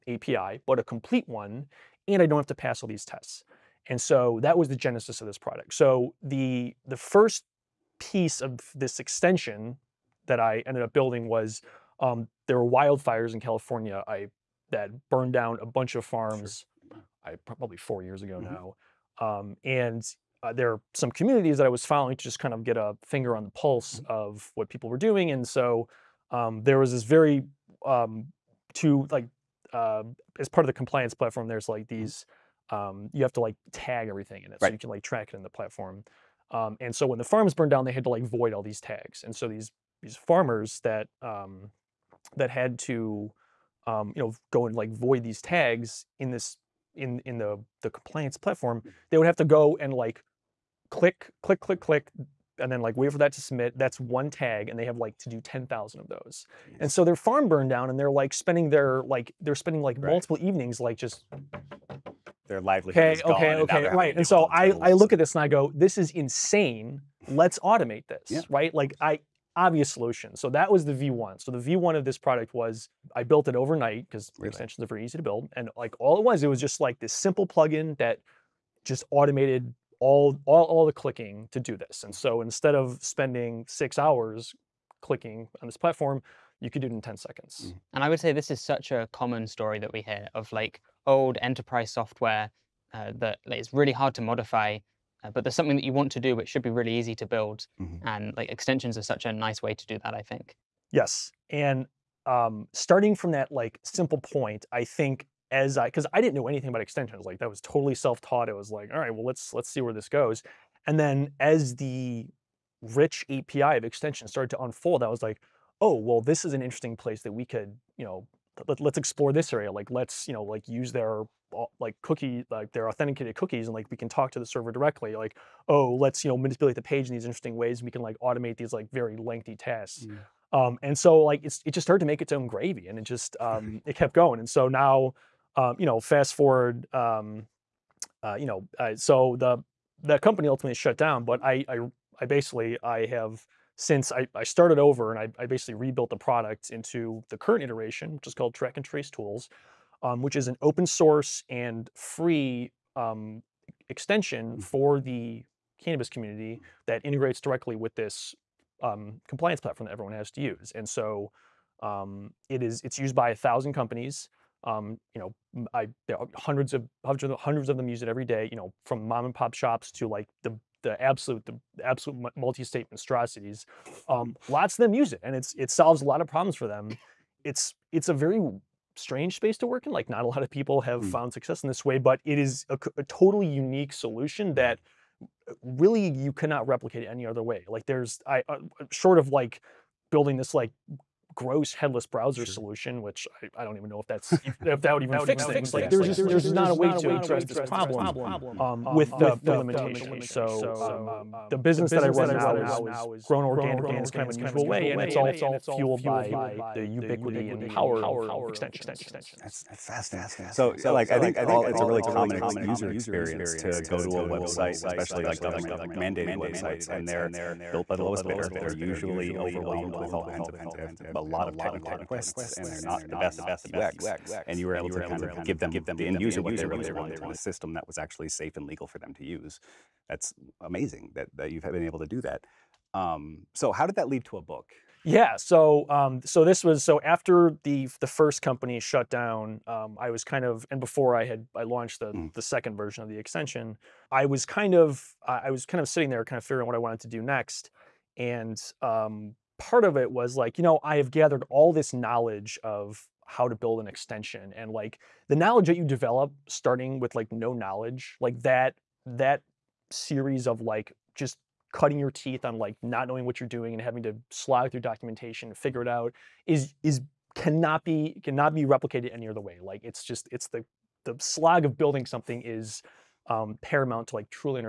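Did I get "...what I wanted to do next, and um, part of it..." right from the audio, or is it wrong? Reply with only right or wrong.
right.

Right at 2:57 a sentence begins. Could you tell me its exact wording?
It's it's a very strange space to work in.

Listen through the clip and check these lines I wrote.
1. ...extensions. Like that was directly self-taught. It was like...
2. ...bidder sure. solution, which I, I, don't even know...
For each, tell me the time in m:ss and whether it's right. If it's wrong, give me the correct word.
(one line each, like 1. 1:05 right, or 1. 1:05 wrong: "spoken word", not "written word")
1. 1:46 wrong: "totally", not "directly"
2. 3:12 wrong: "browser", not "bidder".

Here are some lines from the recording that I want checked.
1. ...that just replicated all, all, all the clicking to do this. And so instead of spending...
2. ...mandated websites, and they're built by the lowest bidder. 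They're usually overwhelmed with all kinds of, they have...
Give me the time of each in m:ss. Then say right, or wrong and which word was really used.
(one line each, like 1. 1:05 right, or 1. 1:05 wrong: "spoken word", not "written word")
1. 1:17 wrong: "automated", not "replicated"
2. 3:35 right.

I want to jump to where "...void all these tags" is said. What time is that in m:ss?
0:38.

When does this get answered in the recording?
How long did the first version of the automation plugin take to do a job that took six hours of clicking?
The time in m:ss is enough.
1:27.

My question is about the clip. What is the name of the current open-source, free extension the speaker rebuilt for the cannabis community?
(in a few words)
Track and Trace Tools.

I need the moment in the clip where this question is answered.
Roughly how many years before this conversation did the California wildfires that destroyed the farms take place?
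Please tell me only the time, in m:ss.
0:17.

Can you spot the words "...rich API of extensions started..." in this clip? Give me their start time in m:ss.
1:52.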